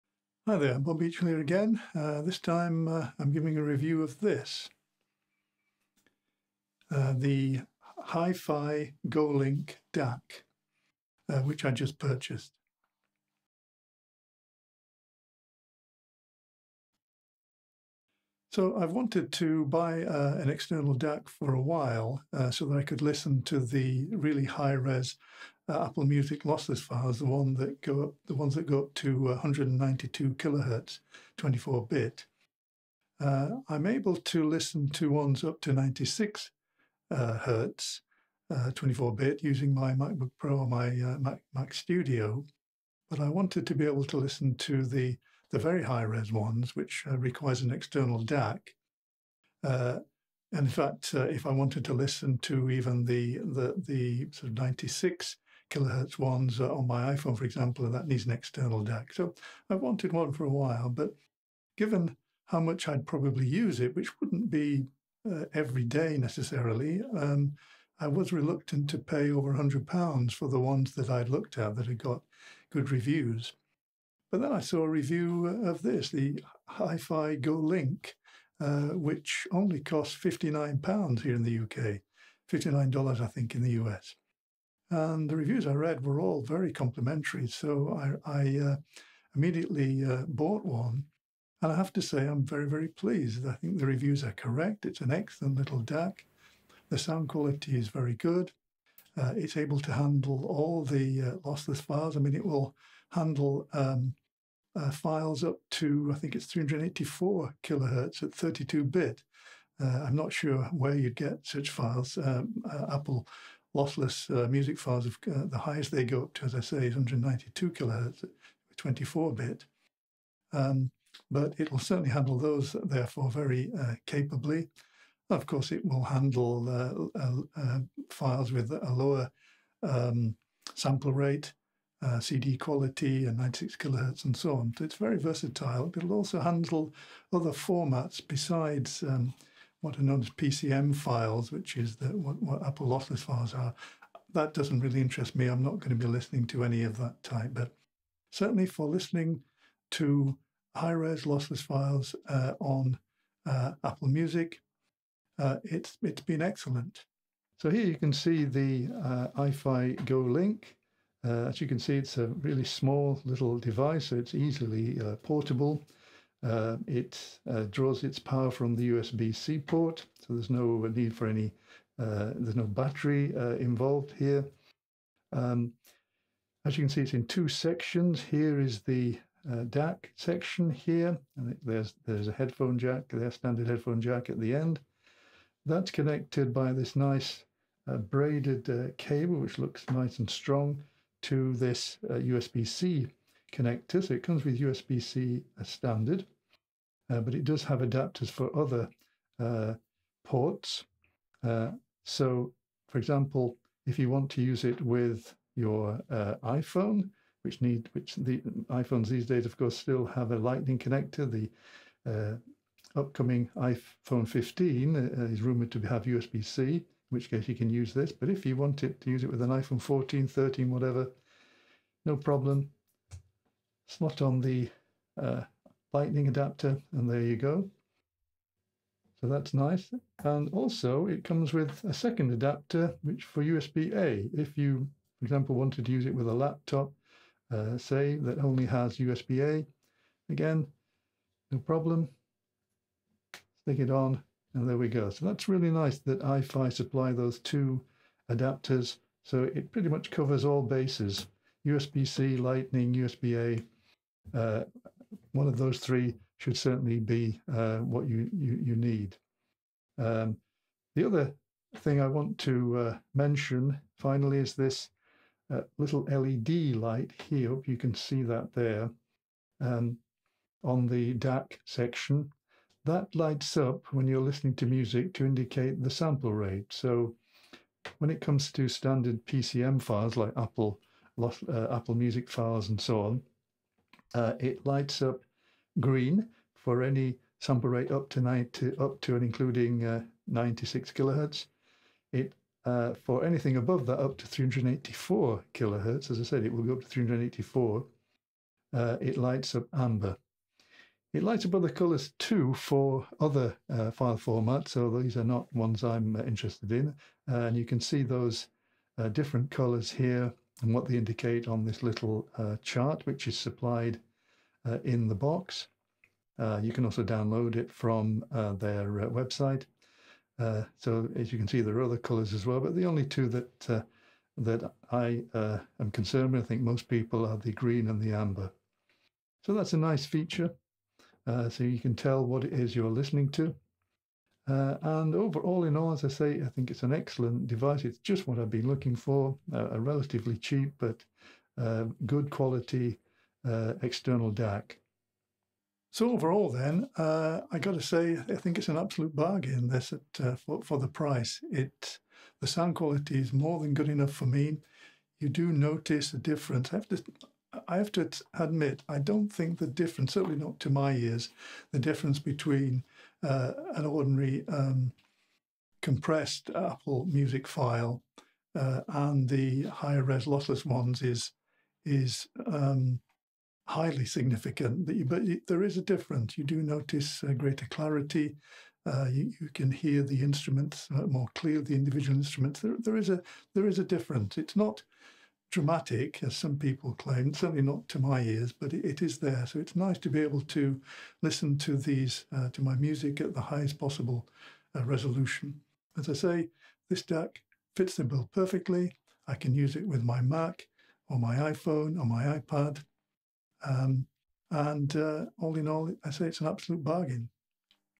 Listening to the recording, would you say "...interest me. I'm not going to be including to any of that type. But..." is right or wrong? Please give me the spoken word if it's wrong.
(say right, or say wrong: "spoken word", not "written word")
wrong: "listening", not "including".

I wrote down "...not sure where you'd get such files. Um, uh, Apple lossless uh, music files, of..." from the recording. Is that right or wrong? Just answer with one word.
right.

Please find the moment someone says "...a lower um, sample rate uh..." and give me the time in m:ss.
2:08.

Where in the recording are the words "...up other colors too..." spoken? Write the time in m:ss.
5:01.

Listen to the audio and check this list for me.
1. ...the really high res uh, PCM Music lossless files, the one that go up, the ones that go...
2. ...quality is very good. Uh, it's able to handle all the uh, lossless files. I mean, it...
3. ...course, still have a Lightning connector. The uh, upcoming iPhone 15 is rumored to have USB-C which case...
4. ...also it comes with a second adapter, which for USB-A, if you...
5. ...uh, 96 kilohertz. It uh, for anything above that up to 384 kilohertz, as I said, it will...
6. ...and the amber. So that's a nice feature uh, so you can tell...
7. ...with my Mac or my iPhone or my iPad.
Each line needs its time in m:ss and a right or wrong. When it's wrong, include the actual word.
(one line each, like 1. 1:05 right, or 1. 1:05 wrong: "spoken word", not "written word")
1. 0:23 wrong: "Apple", not "PCM"
2. 1:37 right
3. 3:29 right
4. 3:50 right
5. 4:49 right
6. 5:27 right
7. 6:39 right.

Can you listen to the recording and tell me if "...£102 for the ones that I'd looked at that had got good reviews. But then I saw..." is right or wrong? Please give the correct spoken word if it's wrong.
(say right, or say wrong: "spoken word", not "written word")
wrong: "100", not "102".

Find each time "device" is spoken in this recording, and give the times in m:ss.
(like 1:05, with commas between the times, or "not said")
2:43, 5:37.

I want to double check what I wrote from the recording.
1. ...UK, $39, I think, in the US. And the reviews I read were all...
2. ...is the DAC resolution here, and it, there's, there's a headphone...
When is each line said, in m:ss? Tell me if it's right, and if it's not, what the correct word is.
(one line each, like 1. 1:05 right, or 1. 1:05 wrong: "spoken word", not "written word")
1. 1:21 wrong: "59", not "39"
2. 2:58 wrong: "section", not "resolution".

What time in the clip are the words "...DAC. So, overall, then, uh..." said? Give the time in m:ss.
5:44.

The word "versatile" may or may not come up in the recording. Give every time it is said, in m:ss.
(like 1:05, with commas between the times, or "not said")
2:15.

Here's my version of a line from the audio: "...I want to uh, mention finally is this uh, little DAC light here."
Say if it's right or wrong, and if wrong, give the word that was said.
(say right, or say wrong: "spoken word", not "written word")
wrong: "LED", not "DAC".